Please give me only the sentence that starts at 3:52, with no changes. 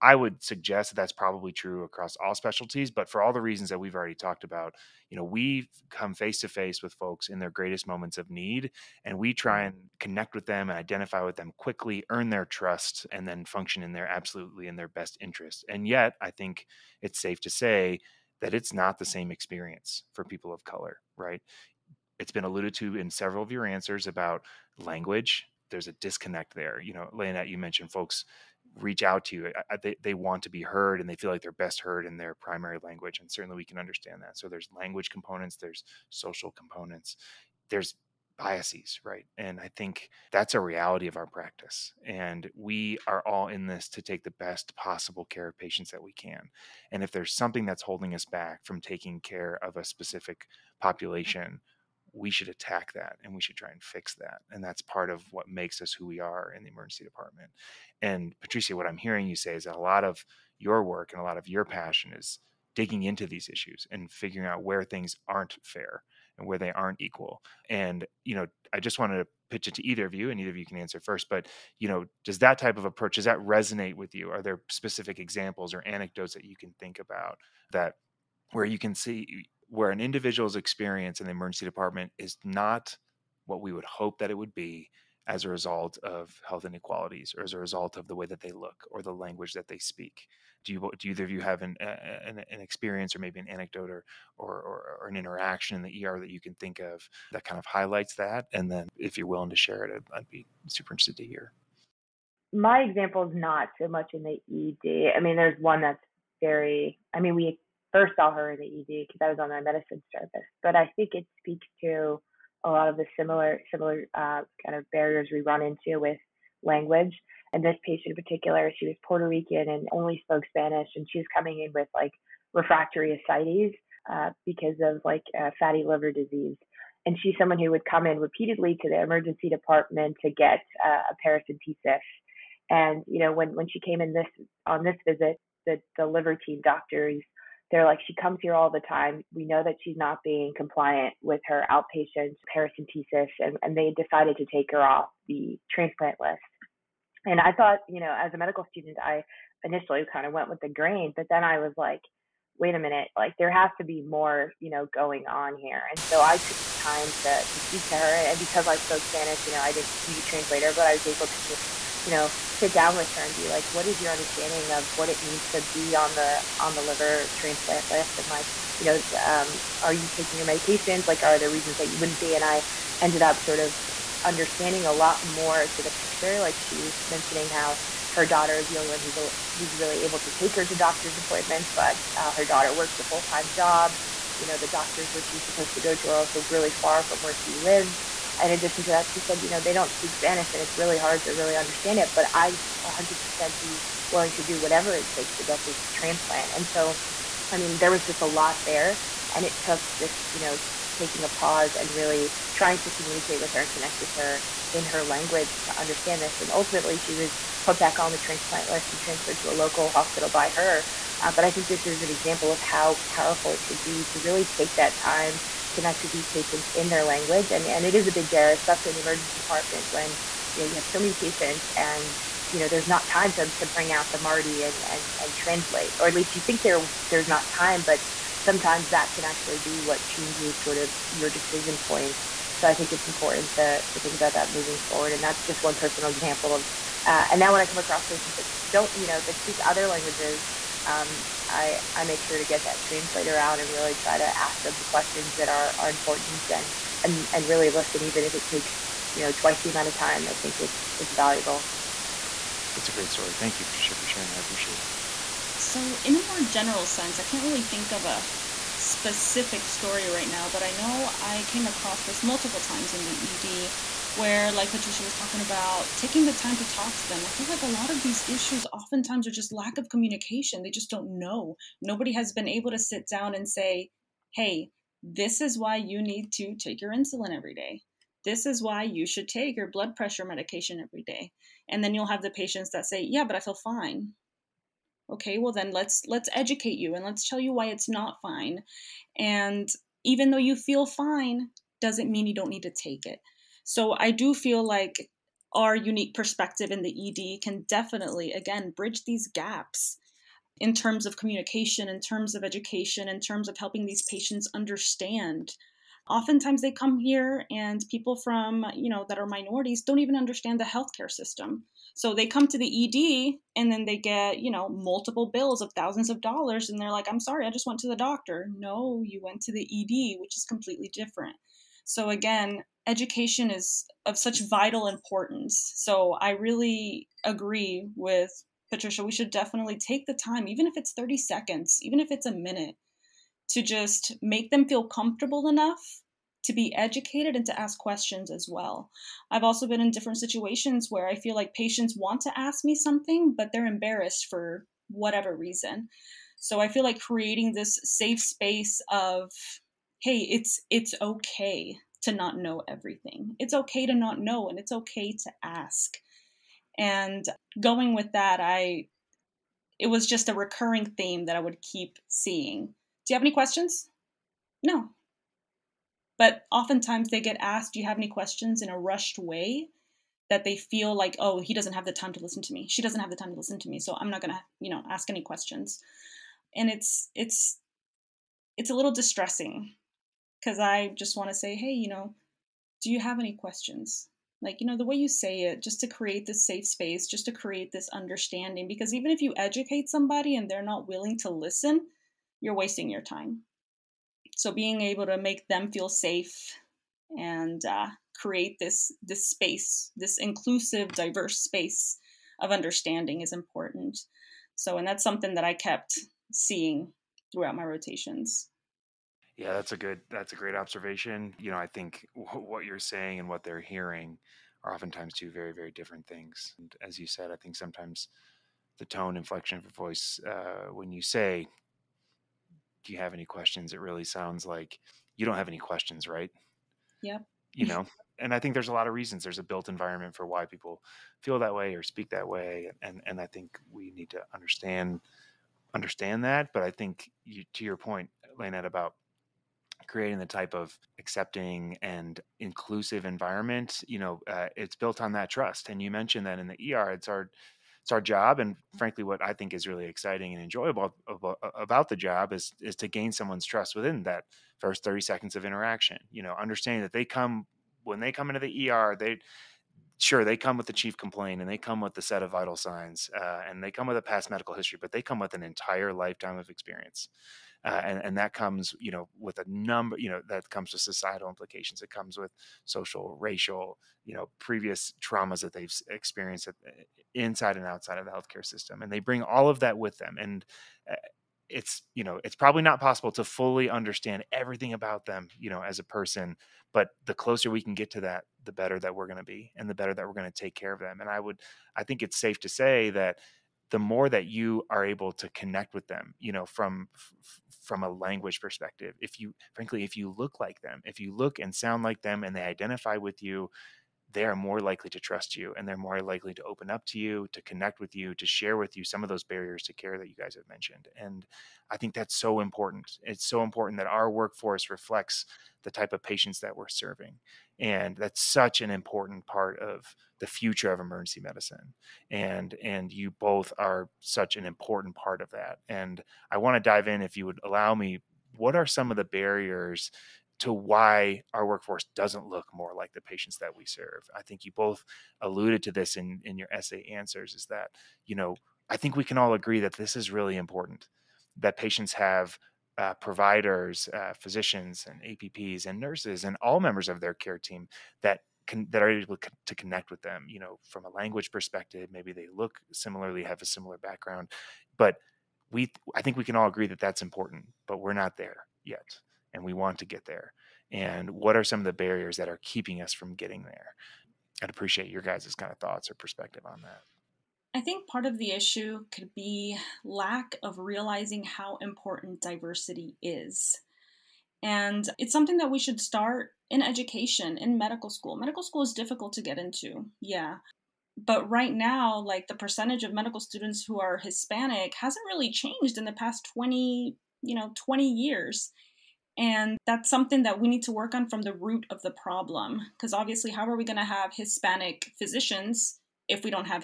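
So I think it's important to to think about that moving forward.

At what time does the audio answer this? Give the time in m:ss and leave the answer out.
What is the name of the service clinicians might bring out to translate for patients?
3:44.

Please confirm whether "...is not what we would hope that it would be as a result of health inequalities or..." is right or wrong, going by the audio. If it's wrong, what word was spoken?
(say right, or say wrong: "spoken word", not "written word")
right.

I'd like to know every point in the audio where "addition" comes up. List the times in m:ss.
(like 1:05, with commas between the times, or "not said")
3:08.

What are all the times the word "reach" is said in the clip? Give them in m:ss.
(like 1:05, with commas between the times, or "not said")
0:28.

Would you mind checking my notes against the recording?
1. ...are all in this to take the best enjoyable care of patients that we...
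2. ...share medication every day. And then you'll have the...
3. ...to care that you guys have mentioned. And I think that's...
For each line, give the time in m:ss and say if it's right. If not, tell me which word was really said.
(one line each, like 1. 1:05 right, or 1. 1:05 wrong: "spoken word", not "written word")
1. 0:43 wrong: "possible", not "enjoyable"
2. 4:39 wrong: "pressure", not "share"
3. 8:29 right.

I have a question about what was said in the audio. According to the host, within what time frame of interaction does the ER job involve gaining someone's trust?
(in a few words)
first thirty seconds.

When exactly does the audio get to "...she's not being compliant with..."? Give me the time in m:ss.
2:19.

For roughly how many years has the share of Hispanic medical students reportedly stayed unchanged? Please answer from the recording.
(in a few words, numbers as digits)
20.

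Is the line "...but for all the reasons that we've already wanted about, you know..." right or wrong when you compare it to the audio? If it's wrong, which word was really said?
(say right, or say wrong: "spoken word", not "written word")
wrong: "talked", not "wanted".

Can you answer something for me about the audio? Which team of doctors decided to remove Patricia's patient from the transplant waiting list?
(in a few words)
the liver team.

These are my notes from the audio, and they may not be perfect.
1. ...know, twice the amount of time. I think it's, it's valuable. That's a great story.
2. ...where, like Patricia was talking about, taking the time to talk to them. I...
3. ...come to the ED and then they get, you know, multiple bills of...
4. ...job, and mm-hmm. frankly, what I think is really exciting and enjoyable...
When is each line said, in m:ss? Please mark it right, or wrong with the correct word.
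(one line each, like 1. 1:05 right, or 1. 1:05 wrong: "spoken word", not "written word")
1. 4:09 right
2. 4:24 right
3. 5:12 right
4. 7:27 right.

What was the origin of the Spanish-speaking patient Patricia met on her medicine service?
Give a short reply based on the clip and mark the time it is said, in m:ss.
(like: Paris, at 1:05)
Puerto Rican, at 1:59.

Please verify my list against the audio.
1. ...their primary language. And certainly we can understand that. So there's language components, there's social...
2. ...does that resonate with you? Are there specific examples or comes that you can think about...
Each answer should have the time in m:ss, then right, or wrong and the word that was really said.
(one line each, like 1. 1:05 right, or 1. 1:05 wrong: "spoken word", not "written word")
1. 0:32 right
2. 1:13 wrong: "anecdotes", not "comes".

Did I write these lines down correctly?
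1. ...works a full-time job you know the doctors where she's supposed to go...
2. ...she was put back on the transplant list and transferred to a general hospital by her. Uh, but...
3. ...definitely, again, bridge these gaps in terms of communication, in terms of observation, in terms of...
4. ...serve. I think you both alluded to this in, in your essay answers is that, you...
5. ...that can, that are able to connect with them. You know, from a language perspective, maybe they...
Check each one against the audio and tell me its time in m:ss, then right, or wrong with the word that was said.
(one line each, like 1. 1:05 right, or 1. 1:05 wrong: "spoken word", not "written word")
1. 3:02 right
2. 3:27 wrong: "local", not "general"
3. 4:57 wrong: "education", not "observation"
4. 8:53 right
5. 9:08 right.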